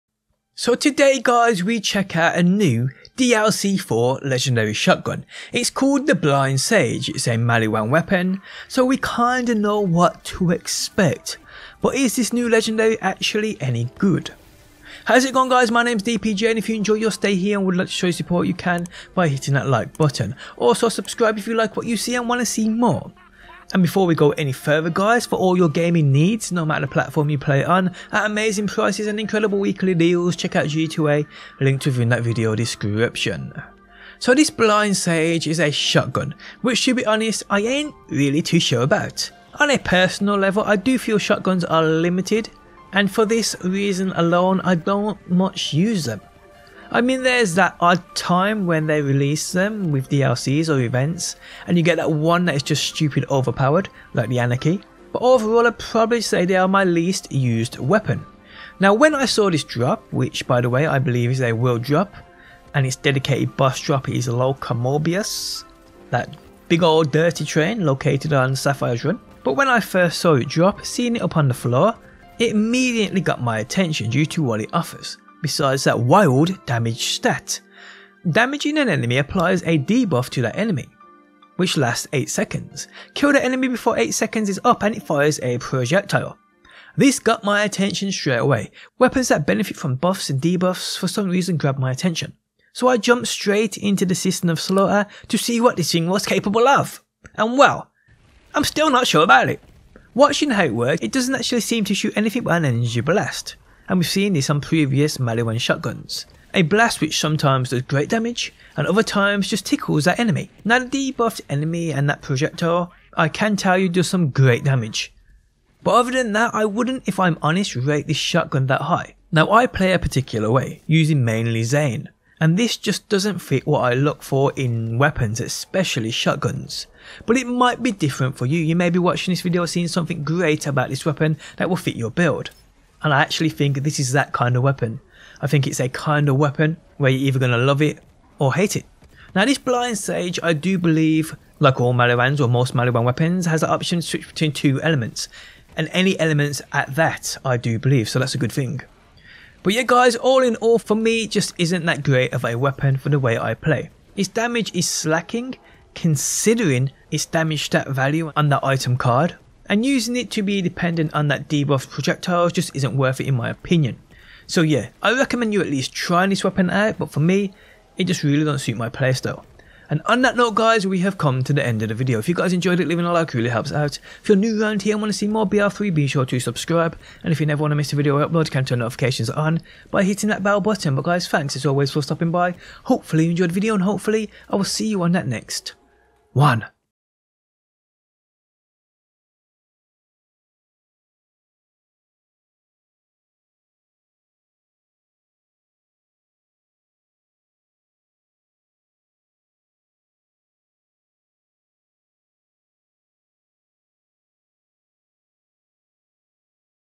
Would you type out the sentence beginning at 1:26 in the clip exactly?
This got my attention straight away.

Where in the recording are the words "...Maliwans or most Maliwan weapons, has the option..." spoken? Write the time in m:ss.
2:21.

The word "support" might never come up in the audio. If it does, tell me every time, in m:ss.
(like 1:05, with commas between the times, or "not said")
0:18.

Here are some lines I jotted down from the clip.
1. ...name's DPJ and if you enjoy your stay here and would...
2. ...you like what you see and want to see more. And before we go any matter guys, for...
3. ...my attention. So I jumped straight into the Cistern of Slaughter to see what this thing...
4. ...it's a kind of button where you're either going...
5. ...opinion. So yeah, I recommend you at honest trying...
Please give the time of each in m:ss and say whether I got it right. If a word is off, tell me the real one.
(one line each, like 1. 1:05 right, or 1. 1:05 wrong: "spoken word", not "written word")
1. 0:15 right
2. 0:21 wrong: "further", not "matter"
3. 1:31 right
4. 2:15 wrong: "weapon", not "button"
5. 2:43 wrong: "least", not "honest".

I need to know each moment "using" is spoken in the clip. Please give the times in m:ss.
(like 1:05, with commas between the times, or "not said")
2:00, 2:39.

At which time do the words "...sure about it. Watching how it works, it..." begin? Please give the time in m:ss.
1:39.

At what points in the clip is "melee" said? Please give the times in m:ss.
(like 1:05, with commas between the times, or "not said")
0:07, 1:45.